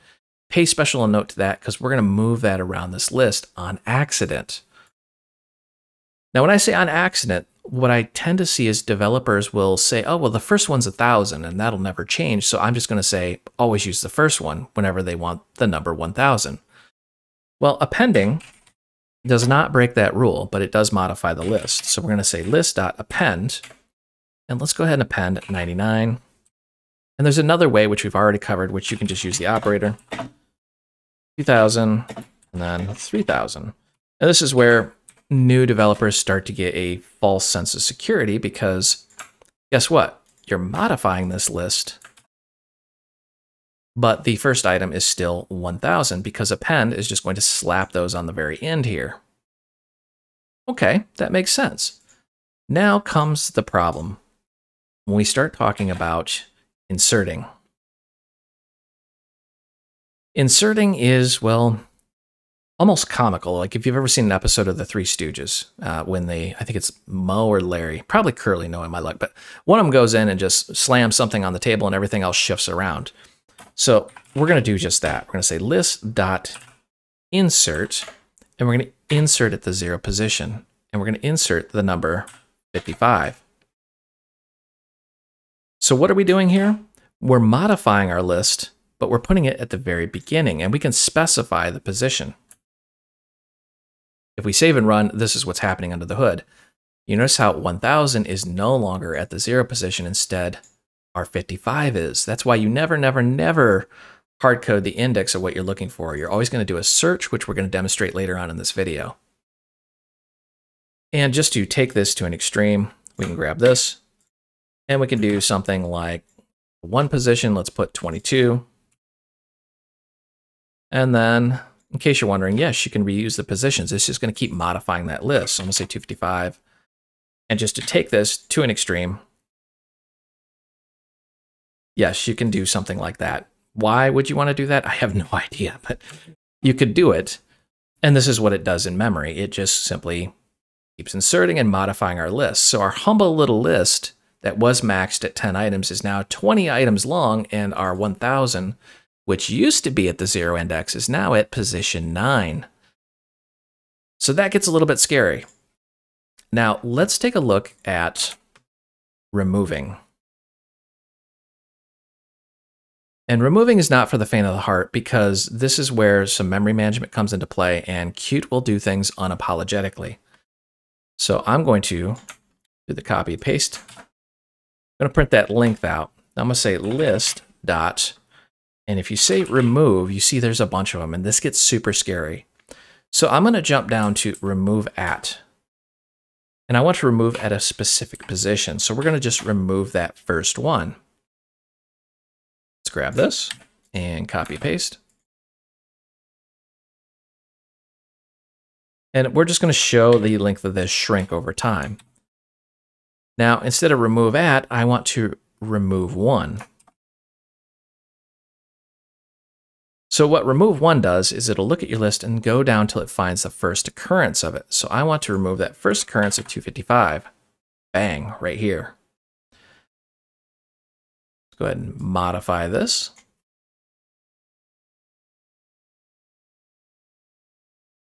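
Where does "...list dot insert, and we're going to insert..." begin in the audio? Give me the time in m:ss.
1:15.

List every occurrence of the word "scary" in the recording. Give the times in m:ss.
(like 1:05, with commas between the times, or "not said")
2:34, 3:01.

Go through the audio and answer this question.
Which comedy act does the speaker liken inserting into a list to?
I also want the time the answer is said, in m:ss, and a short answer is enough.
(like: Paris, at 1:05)
The Three Stooges, at 1:04.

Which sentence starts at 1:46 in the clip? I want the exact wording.
You're always going to do a search, which we're going to demonstrate later on in this video.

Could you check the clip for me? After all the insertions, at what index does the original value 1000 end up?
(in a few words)
9.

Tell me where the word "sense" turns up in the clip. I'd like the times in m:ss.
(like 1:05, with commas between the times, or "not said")
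0:37, 0:51.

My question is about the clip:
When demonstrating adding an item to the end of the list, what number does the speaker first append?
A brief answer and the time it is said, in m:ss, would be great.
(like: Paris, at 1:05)
99, at 0:25.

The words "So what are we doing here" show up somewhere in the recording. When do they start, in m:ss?
1:25.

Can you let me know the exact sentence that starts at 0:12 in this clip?
So I'm just going to say always use the first one whenever they want the number 1000.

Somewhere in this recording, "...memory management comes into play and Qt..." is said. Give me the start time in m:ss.
2:46.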